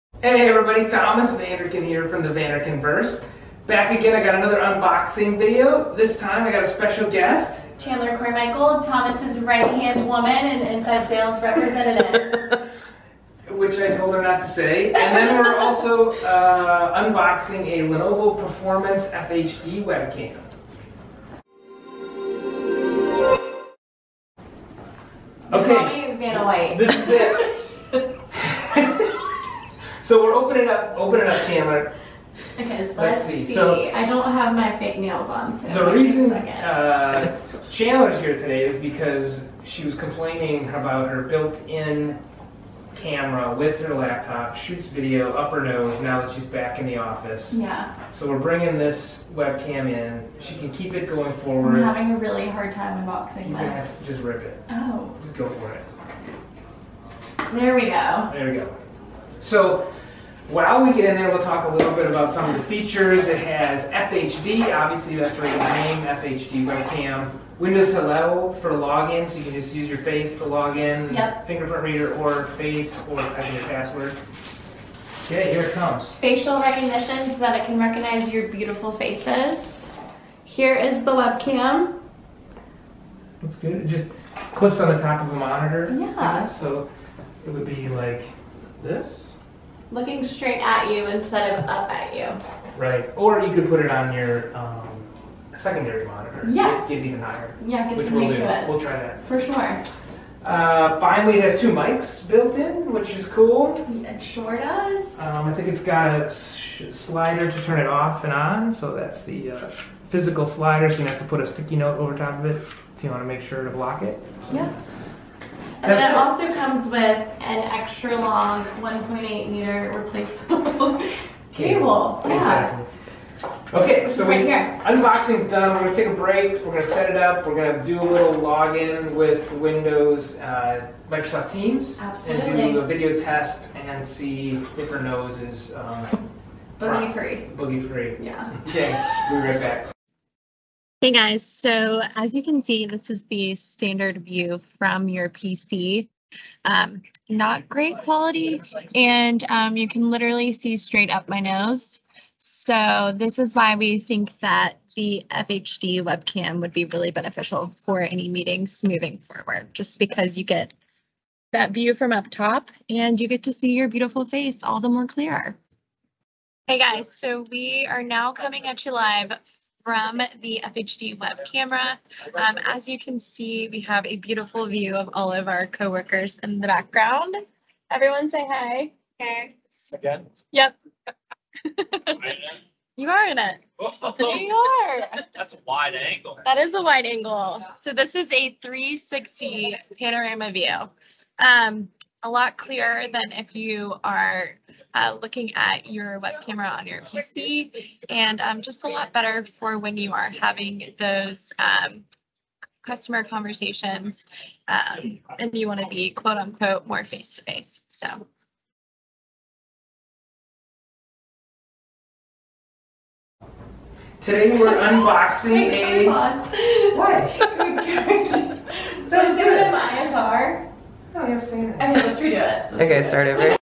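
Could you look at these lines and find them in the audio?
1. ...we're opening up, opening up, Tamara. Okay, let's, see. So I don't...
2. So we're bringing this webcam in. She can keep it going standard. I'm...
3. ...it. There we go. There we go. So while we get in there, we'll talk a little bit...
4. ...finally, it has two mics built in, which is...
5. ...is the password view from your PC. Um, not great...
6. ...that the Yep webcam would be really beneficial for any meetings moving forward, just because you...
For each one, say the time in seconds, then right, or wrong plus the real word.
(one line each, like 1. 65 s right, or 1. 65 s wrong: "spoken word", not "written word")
1. 30 s right
2. 48 s wrong: "forward", not "standard"
3. 55 s right
4. 100 s right
5. 143 s wrong: "standard", not "password"
6. 154 s wrong: "FHD", not "Yep".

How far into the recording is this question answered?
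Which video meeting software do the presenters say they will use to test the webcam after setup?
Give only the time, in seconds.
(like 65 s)
131 s.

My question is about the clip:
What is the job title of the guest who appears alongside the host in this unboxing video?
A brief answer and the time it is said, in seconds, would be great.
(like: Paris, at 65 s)
Inside sales representative, at 10 s.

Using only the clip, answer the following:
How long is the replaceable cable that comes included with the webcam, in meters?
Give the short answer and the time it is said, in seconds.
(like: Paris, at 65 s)
1.8 meters, at 118 s.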